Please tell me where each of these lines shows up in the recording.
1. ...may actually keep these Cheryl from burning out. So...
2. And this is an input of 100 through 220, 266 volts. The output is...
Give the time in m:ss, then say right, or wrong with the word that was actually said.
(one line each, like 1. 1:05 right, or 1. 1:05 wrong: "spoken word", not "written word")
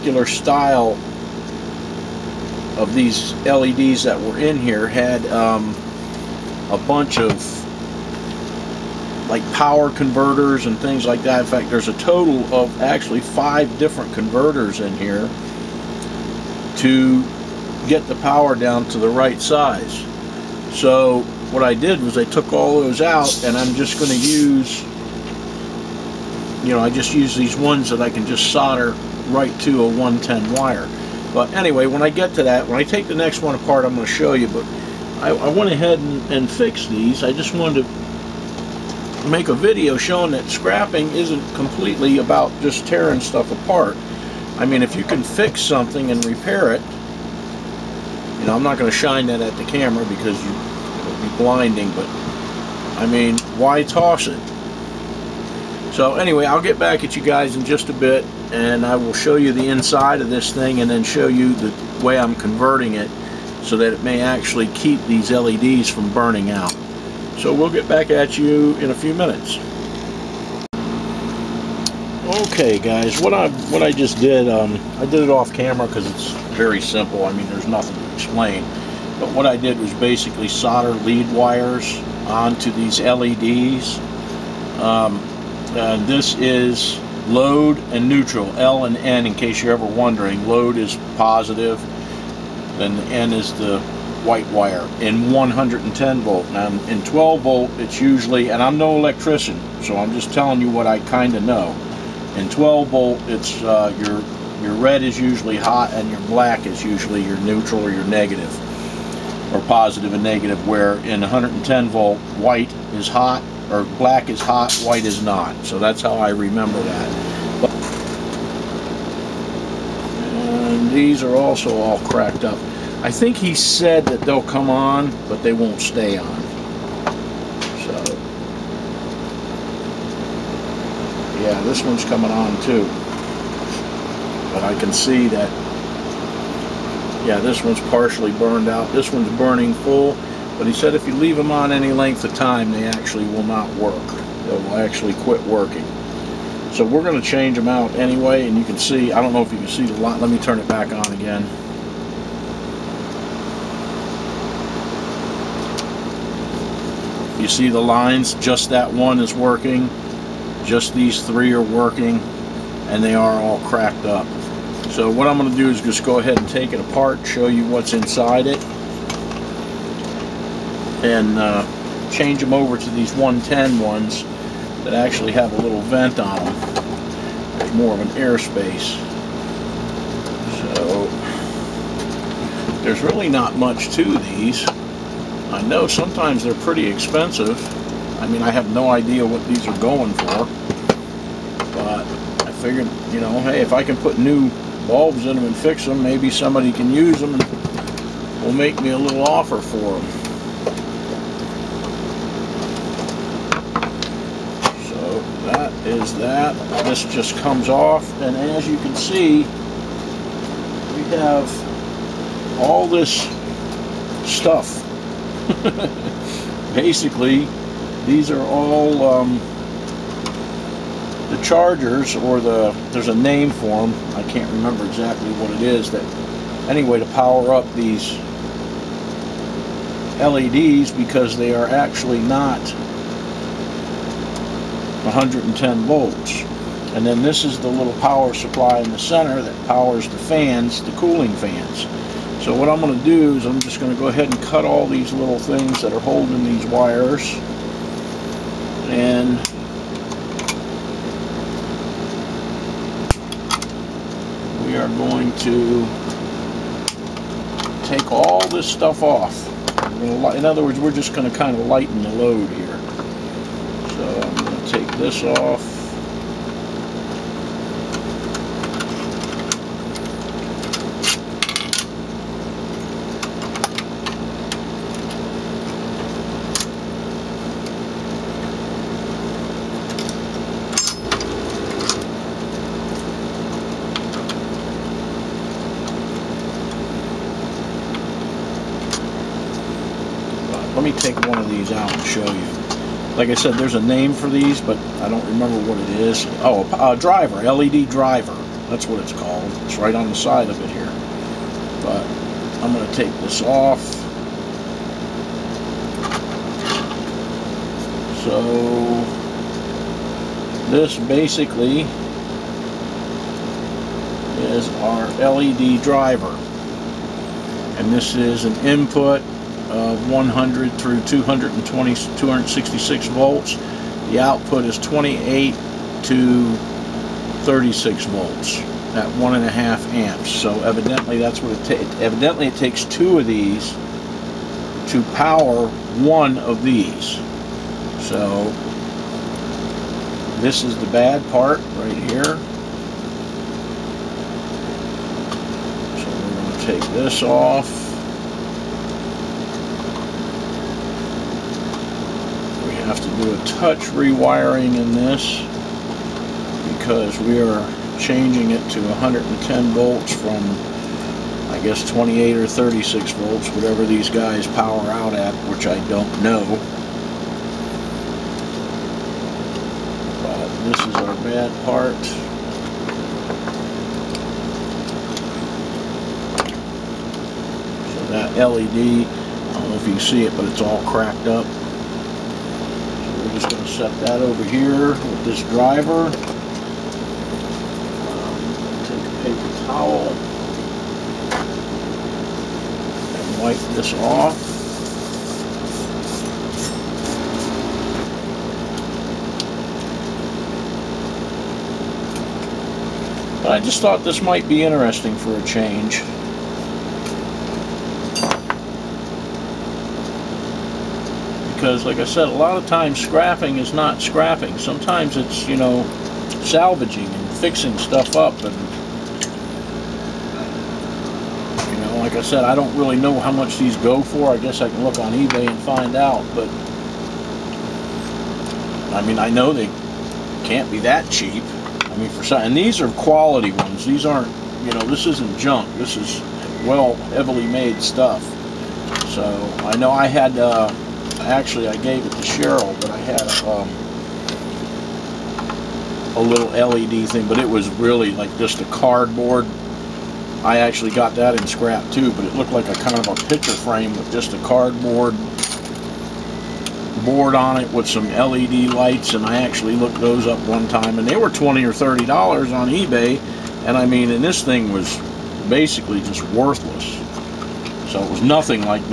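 1. 1:04 wrong: "LEDs", not "Cheryl"
2. 5:17 right.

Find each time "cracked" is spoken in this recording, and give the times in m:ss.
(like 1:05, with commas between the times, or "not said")
2:02, 2:43, 6:20.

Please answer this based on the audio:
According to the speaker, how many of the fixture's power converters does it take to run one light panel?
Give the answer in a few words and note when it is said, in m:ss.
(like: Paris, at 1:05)
2, at 5:32.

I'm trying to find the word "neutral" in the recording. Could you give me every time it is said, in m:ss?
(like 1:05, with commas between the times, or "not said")
1:28, 1:47.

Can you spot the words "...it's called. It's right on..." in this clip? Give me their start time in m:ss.
4:59.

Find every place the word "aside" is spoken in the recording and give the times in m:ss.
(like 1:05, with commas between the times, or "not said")
not said.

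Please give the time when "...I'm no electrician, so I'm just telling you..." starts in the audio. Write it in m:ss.
1:38.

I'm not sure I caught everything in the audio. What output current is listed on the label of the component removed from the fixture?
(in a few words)
1.5 amps.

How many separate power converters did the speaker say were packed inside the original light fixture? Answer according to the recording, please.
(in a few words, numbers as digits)
5.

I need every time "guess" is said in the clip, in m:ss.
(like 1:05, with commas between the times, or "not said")
6:01, 7:04.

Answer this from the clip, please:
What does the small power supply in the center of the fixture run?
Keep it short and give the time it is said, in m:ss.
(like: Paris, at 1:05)
cooling fans, at 4:00.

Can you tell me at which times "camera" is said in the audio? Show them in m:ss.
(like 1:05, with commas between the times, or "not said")
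0:49, 1:15.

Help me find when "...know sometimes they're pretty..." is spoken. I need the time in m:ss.
3:05.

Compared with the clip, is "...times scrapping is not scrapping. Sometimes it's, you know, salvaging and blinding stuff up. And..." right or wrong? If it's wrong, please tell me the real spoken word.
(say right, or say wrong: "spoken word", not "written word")
wrong: "fixing", not "blinding".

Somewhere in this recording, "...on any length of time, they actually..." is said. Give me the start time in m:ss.
2:21.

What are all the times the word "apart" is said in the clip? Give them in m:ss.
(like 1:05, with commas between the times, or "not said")
0:33, 0:43, 2:46.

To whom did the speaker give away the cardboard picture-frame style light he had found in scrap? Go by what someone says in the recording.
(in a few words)
Cheryl.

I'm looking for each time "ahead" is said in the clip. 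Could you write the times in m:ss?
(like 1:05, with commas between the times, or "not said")
0:35, 2:46, 4:04.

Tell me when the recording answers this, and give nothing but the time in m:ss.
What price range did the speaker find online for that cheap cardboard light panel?
7:41.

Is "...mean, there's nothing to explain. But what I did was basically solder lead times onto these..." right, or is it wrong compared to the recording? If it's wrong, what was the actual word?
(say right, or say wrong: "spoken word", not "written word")
wrong: "wires", not "times".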